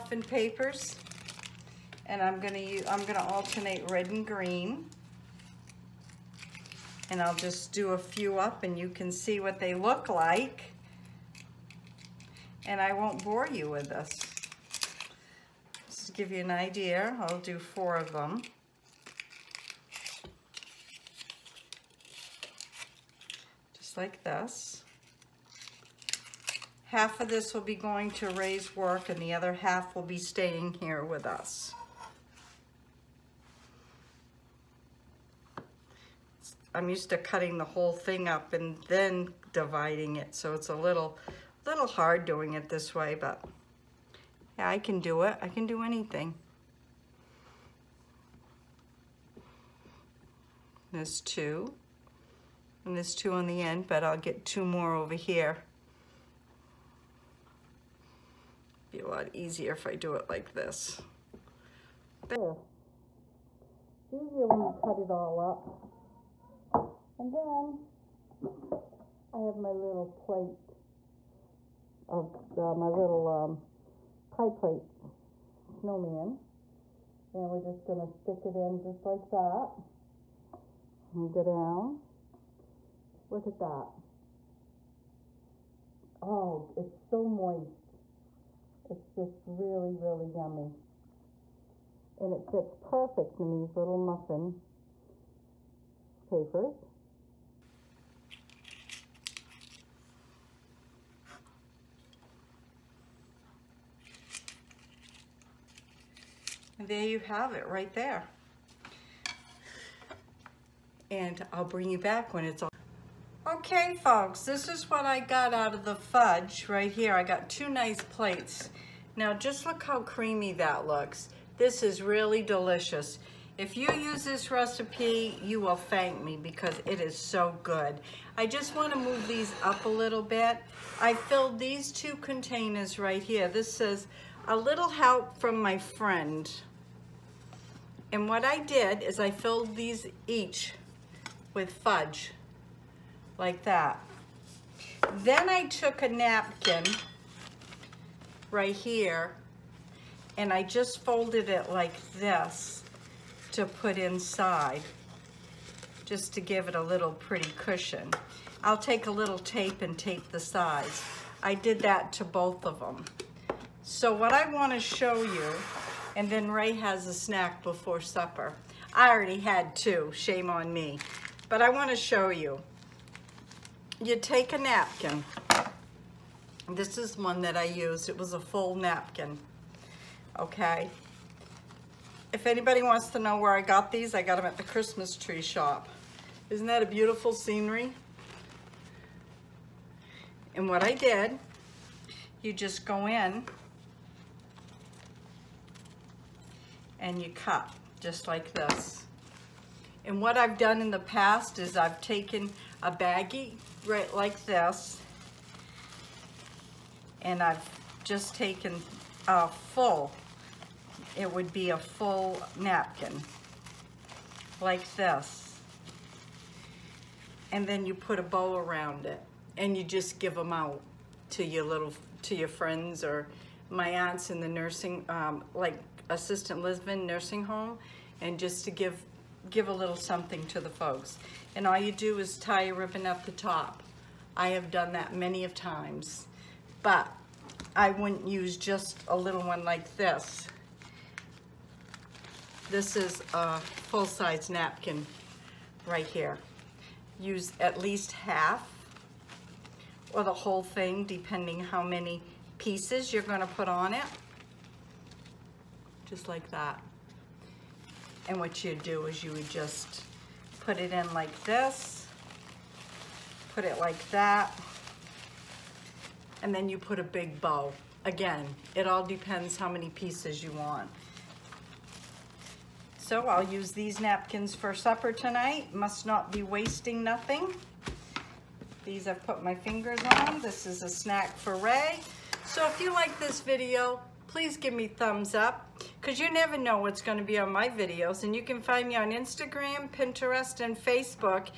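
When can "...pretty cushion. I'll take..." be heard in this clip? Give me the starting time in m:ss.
2:37.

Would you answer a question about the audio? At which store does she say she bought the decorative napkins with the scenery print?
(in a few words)
Christmas Tree Shop.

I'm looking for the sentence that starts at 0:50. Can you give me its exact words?
There's two and there's two on the end, but I'll get two more over here.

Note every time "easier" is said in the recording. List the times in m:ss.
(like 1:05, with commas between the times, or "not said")
0:59, 1:04.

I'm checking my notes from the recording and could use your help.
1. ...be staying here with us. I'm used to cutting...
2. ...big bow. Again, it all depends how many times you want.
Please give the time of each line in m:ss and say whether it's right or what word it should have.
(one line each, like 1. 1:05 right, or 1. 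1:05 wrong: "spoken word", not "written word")
1. 0:30 right
2. 4:27 wrong: "pieces", not "times".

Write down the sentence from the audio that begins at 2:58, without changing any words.
It was a full napkin, okay?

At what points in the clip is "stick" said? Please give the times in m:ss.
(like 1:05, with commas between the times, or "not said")
1:18.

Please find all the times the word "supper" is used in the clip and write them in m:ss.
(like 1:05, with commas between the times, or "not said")
2:48, 4:34.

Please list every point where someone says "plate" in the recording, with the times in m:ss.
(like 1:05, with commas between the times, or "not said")
1:10, 1:14, 1:58.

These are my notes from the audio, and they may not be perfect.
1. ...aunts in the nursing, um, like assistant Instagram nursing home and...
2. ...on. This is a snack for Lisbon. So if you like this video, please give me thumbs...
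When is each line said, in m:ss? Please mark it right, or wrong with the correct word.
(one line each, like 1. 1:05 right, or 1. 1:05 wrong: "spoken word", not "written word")
1. 3:43 wrong: "Lisbon", not "Instagram"
2. 4:40 wrong: "Ray", not "Lisbon".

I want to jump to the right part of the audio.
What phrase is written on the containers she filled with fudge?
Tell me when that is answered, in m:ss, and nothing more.
2:14.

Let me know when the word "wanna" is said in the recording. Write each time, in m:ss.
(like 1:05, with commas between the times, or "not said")
2:44, 2:51.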